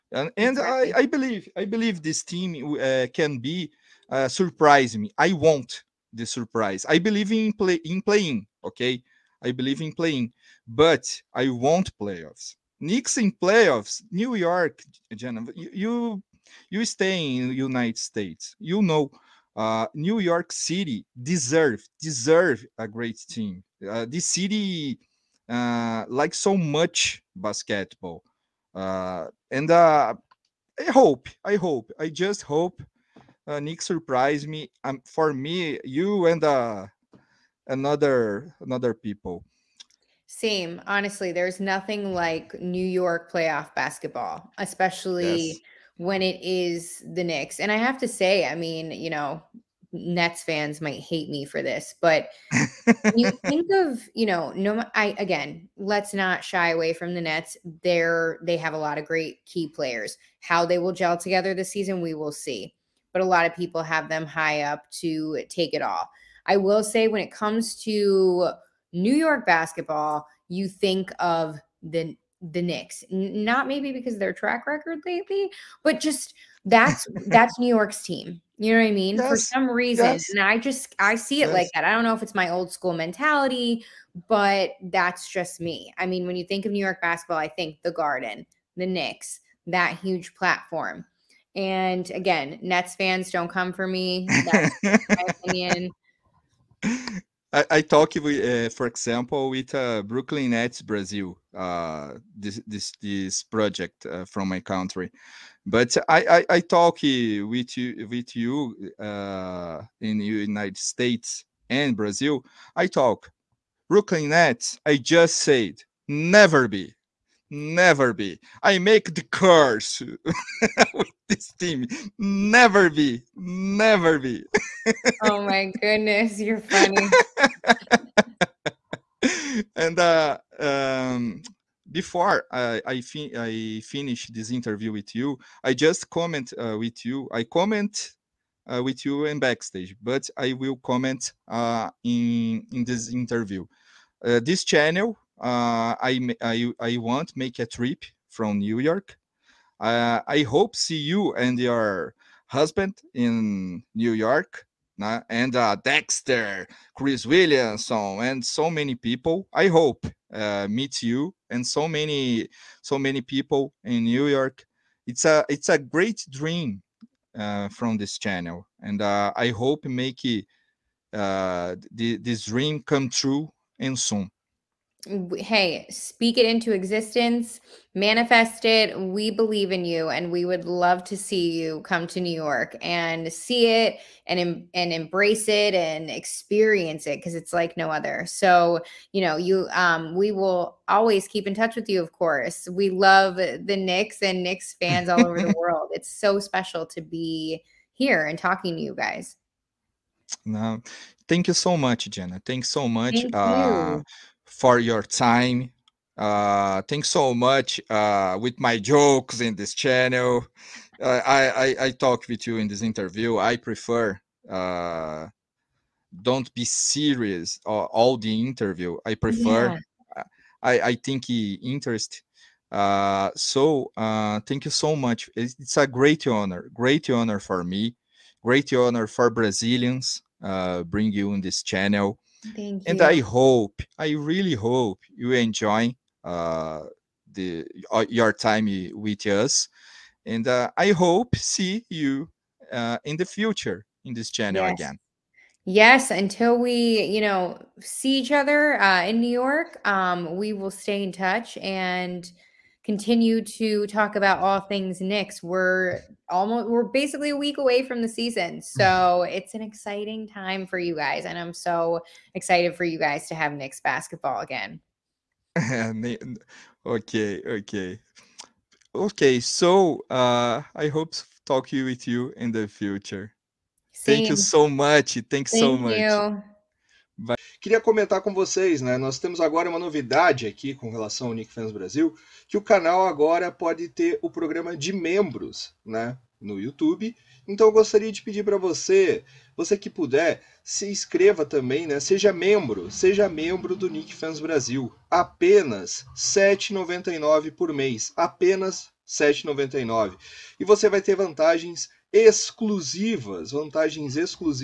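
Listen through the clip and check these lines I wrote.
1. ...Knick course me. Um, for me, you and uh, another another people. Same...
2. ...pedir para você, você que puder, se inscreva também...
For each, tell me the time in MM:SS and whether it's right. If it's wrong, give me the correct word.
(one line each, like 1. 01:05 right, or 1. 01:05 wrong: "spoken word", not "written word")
1. 00:33 wrong: "surprise", not "course"
2. 04:48 right.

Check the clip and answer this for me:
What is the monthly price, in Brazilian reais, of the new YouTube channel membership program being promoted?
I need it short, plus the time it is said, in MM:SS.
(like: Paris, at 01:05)
R$ 7.99, at 04:56.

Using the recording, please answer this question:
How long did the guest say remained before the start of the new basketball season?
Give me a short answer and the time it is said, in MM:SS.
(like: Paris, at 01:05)
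a week, at 04:17.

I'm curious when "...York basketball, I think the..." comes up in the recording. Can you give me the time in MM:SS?
01:26.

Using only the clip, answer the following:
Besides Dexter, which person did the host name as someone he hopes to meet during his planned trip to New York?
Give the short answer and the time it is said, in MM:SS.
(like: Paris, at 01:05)
Chris Williamson, at 02:36.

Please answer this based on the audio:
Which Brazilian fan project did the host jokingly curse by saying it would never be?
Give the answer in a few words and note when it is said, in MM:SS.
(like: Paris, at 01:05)
Brooklyn Nets Brazil, at 01:40.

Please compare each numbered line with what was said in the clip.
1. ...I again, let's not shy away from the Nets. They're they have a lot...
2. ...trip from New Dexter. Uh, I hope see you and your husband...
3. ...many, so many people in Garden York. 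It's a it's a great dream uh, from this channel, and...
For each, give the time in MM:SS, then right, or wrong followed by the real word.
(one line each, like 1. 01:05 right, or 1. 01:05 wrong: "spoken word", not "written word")
1. 00:54 right
2. 02:27 wrong: "York", not "Dexter"
3. 02:41 wrong: "New", not "Garden".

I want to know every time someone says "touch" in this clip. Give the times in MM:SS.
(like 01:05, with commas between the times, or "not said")
03:11, 04:11.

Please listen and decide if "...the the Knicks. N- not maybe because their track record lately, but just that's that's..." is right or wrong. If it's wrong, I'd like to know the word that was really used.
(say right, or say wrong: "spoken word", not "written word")
right.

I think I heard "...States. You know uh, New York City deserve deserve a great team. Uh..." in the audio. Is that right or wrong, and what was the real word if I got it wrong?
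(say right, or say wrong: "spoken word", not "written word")
right.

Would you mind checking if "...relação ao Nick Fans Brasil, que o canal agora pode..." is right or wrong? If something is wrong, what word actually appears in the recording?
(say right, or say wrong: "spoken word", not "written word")
right.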